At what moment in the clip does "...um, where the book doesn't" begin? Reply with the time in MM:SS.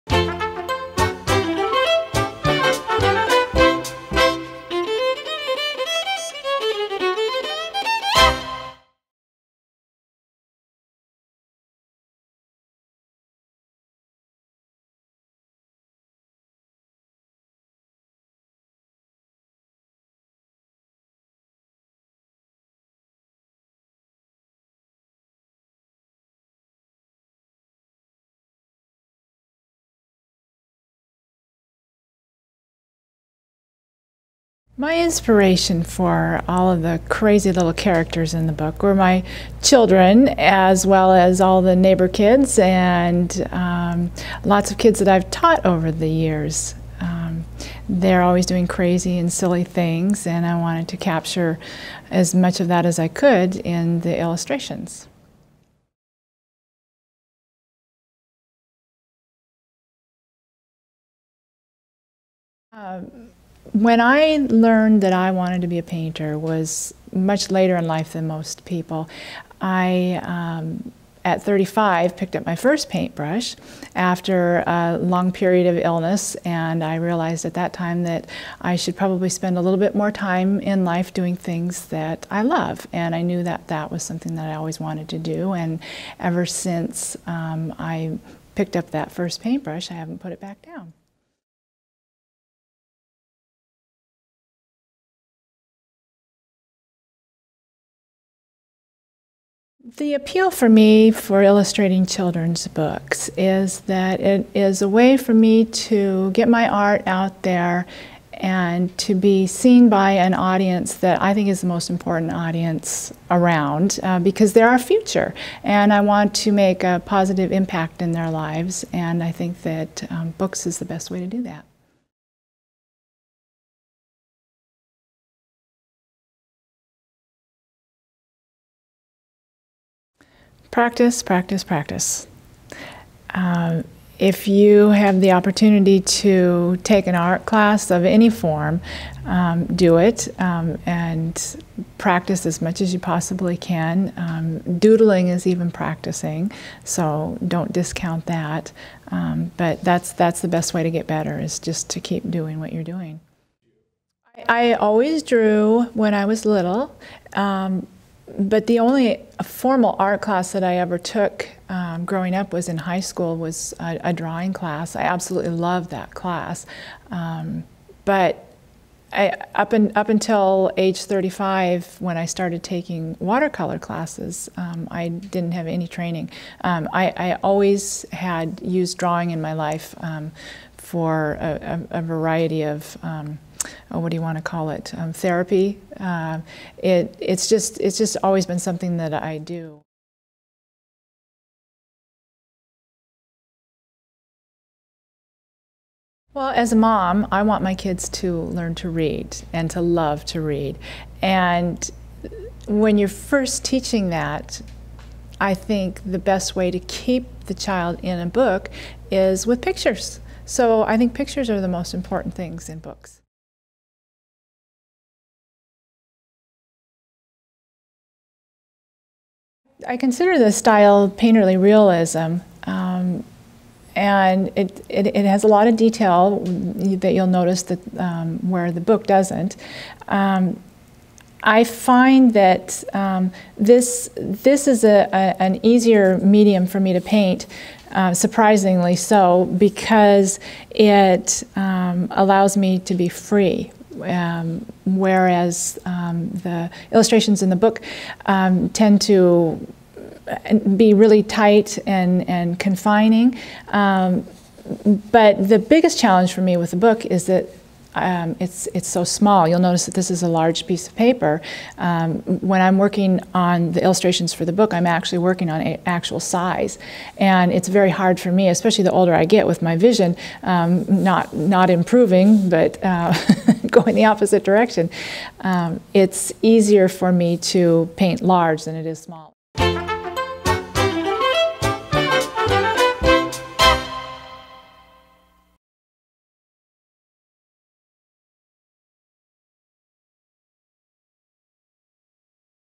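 03:47.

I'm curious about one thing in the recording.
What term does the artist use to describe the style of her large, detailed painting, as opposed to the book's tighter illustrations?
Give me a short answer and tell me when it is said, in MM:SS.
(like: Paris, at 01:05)
painterly realism, at 03:41.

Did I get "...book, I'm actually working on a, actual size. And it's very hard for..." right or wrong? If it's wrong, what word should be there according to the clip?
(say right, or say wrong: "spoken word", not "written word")
right.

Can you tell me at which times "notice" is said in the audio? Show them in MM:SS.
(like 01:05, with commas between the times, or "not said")
03:47, 04:19.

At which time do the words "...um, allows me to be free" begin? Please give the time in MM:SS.
04:01.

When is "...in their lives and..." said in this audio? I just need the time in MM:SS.
01:58.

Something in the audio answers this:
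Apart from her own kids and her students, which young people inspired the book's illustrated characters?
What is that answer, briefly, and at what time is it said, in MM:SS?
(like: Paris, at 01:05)
neighbor kids, at 00:41.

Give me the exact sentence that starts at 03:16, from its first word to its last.
Well, as a mom, I want my kids to learn to read and to love to read.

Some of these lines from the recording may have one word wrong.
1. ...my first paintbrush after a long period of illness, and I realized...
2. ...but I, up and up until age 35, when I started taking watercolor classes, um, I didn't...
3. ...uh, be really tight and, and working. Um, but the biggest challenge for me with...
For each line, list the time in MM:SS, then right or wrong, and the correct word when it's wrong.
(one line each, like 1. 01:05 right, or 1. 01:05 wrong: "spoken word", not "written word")
1. 01:12 right
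2. 02:48 right
3. 04:10 wrong: "confining", not "working".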